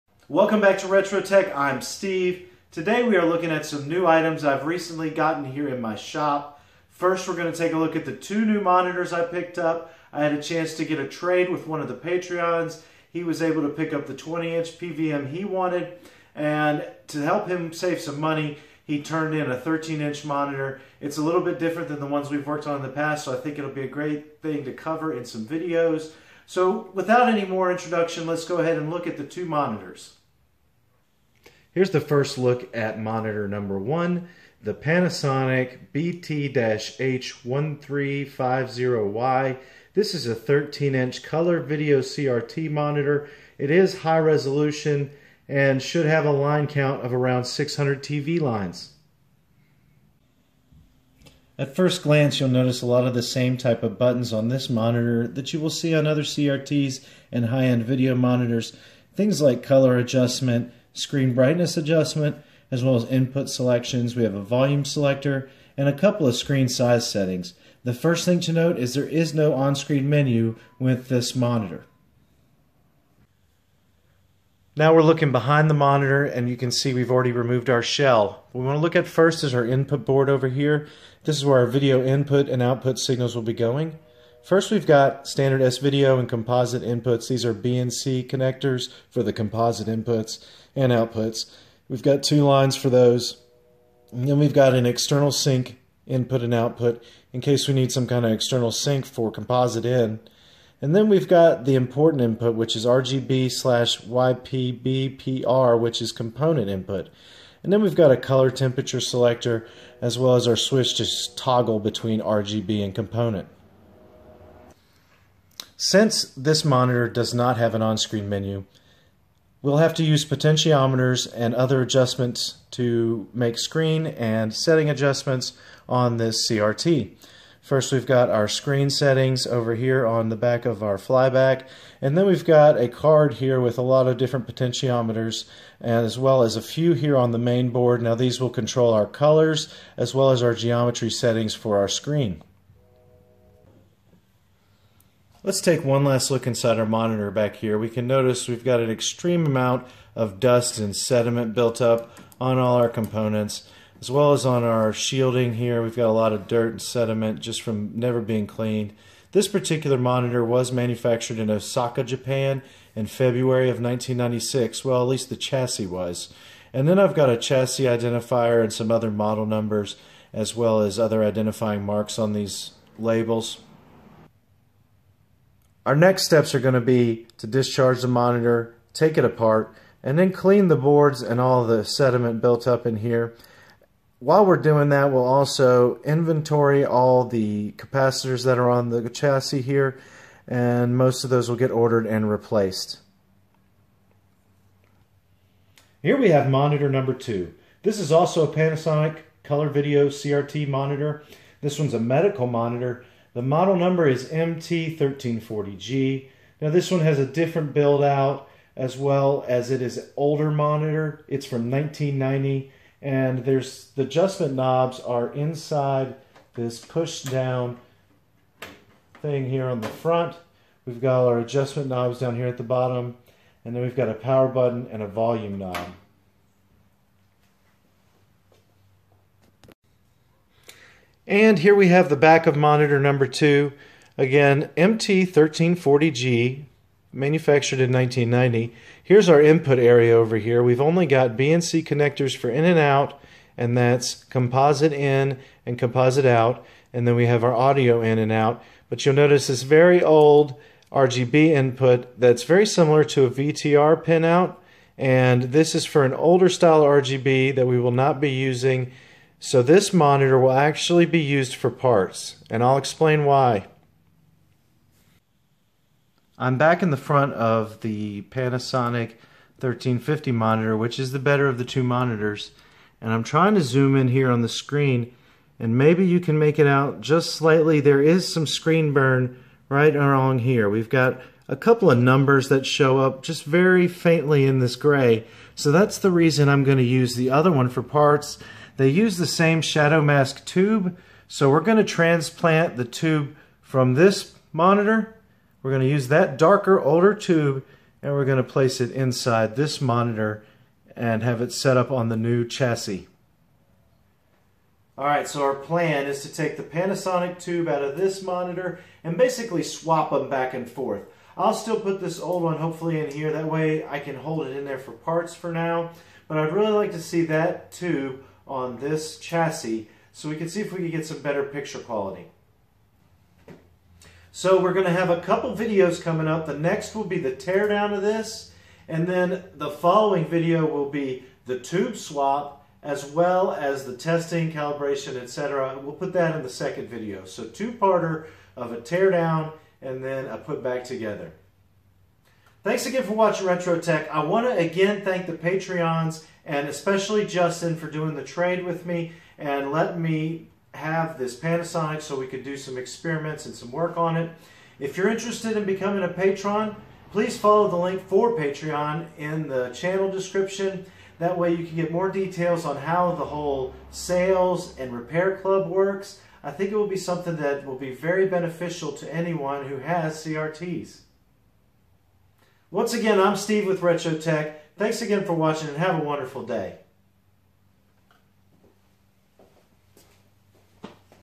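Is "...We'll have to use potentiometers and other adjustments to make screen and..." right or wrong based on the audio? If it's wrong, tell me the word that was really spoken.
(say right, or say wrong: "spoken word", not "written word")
right.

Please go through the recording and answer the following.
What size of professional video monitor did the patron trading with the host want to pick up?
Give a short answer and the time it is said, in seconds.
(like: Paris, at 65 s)
20-inch, at 14 s.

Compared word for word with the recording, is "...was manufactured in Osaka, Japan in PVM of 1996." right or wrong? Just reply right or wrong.
wrong.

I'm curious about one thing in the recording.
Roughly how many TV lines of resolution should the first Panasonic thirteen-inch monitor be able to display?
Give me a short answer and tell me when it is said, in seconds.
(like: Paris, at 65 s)
600, at 47 s.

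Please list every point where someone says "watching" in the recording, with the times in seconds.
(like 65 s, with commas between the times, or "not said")
343 s, 375 s.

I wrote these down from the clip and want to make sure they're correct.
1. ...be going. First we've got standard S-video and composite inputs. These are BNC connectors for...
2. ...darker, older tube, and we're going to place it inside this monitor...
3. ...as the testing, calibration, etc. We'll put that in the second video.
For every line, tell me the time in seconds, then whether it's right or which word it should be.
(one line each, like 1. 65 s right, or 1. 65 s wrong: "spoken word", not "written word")
1. 83 s right
2. 296 s right
3. 333 s right.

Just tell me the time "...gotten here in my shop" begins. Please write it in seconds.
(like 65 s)
5 s.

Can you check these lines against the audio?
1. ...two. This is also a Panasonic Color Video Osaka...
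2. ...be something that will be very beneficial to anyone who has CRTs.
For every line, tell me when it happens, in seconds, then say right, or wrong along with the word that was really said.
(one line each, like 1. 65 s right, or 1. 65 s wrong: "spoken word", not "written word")
1. 197 s wrong: "CRT", not "Osaka"
2. 366 s right.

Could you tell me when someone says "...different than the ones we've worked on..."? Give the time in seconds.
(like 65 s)
21 s.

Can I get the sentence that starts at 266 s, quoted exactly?
I'm back in the front of the Panasonic 1350 monitor, which is the better of the two monitors.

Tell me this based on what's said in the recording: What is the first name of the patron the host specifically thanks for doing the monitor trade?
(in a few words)
Justin.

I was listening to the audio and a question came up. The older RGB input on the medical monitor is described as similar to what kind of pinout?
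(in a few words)
VTR pinout.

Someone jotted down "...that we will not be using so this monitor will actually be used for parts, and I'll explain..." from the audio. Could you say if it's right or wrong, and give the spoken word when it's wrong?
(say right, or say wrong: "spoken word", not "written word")
right.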